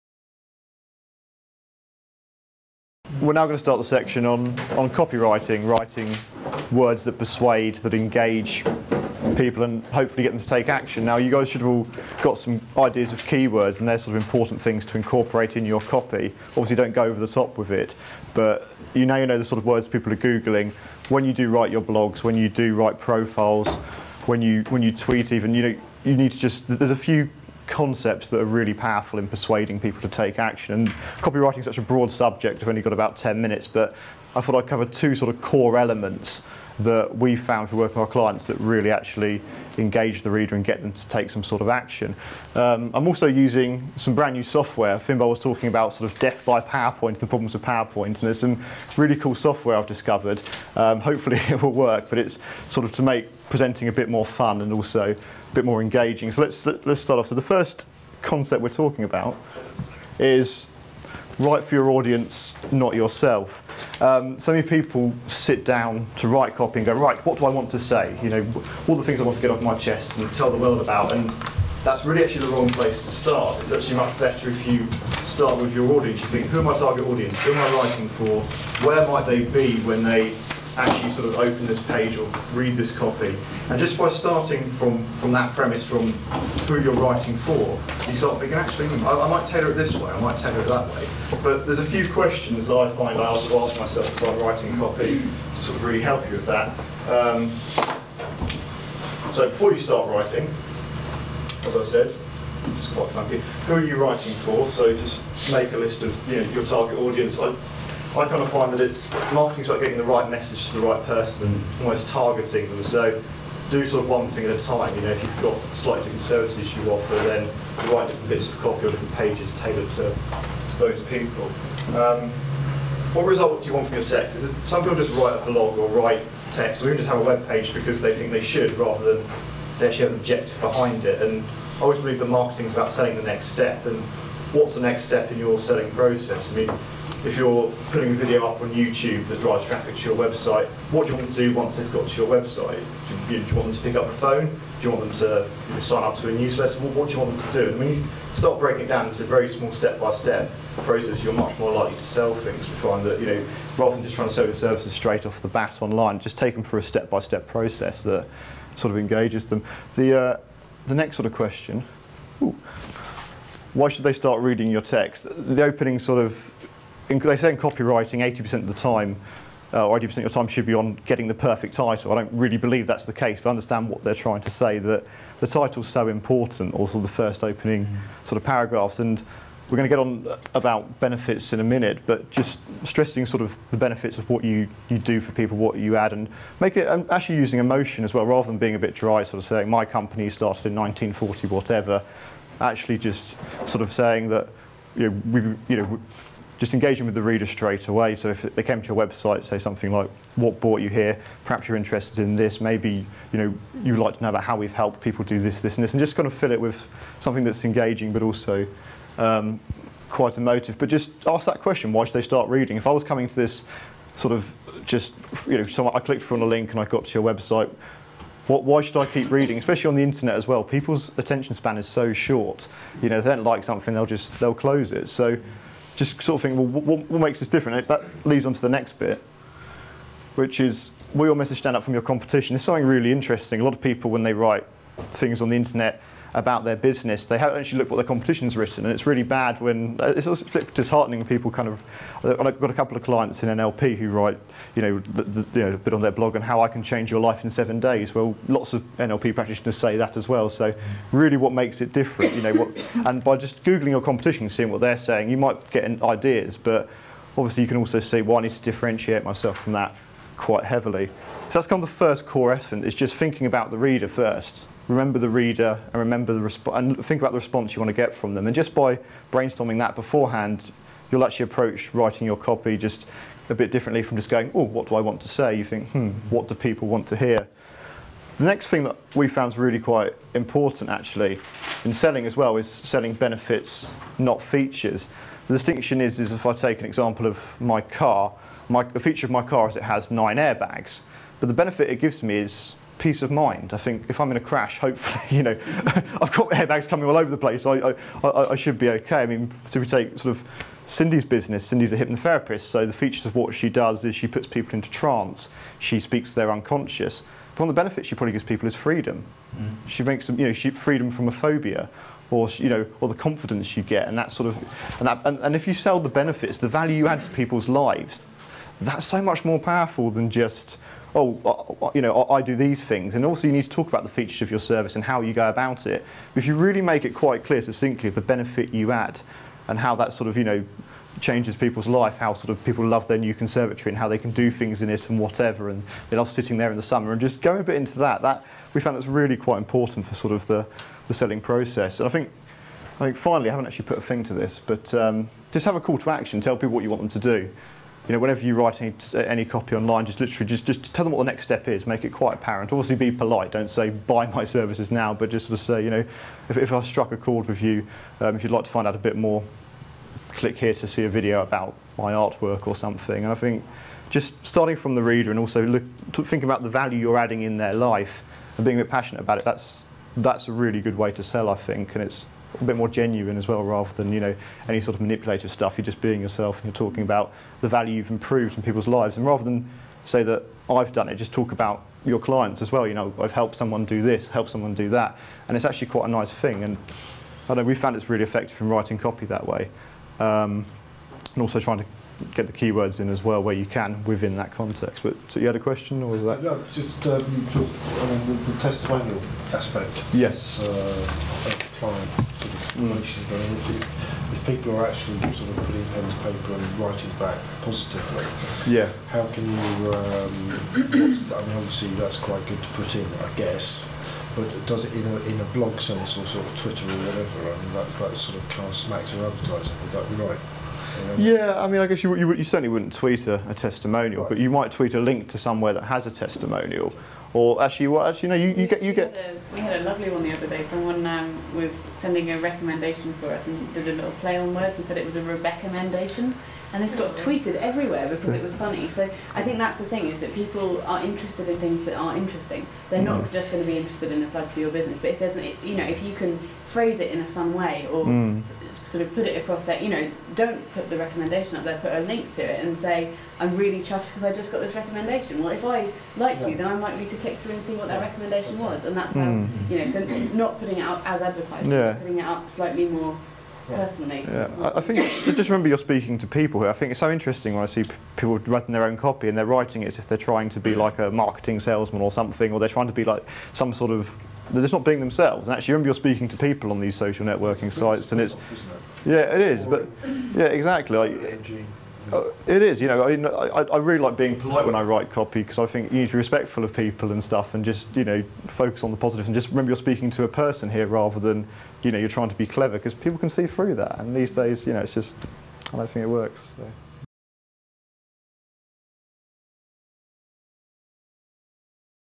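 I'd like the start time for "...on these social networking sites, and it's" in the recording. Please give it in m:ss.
7:56.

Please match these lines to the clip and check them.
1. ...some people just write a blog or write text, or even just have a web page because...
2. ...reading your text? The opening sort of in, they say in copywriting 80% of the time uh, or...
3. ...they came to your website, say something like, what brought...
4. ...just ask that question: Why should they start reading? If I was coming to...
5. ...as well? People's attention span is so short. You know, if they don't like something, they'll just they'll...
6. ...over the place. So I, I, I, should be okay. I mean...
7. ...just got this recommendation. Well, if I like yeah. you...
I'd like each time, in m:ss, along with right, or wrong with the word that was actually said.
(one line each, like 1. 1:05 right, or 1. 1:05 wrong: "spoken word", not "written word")
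1. 2:04 right
2. 2:44 right
3. 3:18 right
4. 3:30 right
5. 3:40 right
6. 4:57 right
7. 7:34 right.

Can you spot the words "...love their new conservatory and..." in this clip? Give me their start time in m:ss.
5:32.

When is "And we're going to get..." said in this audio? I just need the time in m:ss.
2:58.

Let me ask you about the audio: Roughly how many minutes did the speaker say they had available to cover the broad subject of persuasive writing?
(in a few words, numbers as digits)
10.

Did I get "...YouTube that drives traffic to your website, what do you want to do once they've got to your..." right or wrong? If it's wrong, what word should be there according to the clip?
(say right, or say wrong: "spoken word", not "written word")
right.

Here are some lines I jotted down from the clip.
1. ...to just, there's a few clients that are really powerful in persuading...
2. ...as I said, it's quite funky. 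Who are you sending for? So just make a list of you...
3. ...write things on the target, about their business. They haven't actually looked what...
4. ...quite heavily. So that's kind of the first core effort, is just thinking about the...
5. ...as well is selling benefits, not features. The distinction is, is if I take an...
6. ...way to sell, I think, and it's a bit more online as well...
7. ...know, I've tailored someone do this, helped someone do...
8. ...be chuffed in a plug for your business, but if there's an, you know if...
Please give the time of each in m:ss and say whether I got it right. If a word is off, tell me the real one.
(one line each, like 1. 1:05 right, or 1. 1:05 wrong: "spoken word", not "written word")
1. 0:26 wrong: "concepts", not "clients"
2. 1:41 wrong: "writing", not "sending"
3. 3:54 wrong: "internet", not "target"
4. 4:20 right
5. 4:42 right
6. 6:10 wrong: "genuine", not "online"
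7. 6:22 wrong: "helped", not "tailored"
8. 7:23 wrong: "interested", not "chuffed".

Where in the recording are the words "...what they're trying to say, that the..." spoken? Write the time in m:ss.
2:53.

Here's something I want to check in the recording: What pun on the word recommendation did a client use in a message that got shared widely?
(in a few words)
Rebecca mendation.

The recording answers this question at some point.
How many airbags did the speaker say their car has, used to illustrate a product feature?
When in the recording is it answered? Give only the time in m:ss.
4:50.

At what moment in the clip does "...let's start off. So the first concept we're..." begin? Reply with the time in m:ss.
0:56.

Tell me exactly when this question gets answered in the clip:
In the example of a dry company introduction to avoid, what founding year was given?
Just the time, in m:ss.
3:10.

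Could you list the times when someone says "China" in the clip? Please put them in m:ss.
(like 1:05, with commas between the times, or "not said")
not said.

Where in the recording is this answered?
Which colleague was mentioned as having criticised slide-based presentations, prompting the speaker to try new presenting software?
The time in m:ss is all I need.
0:44.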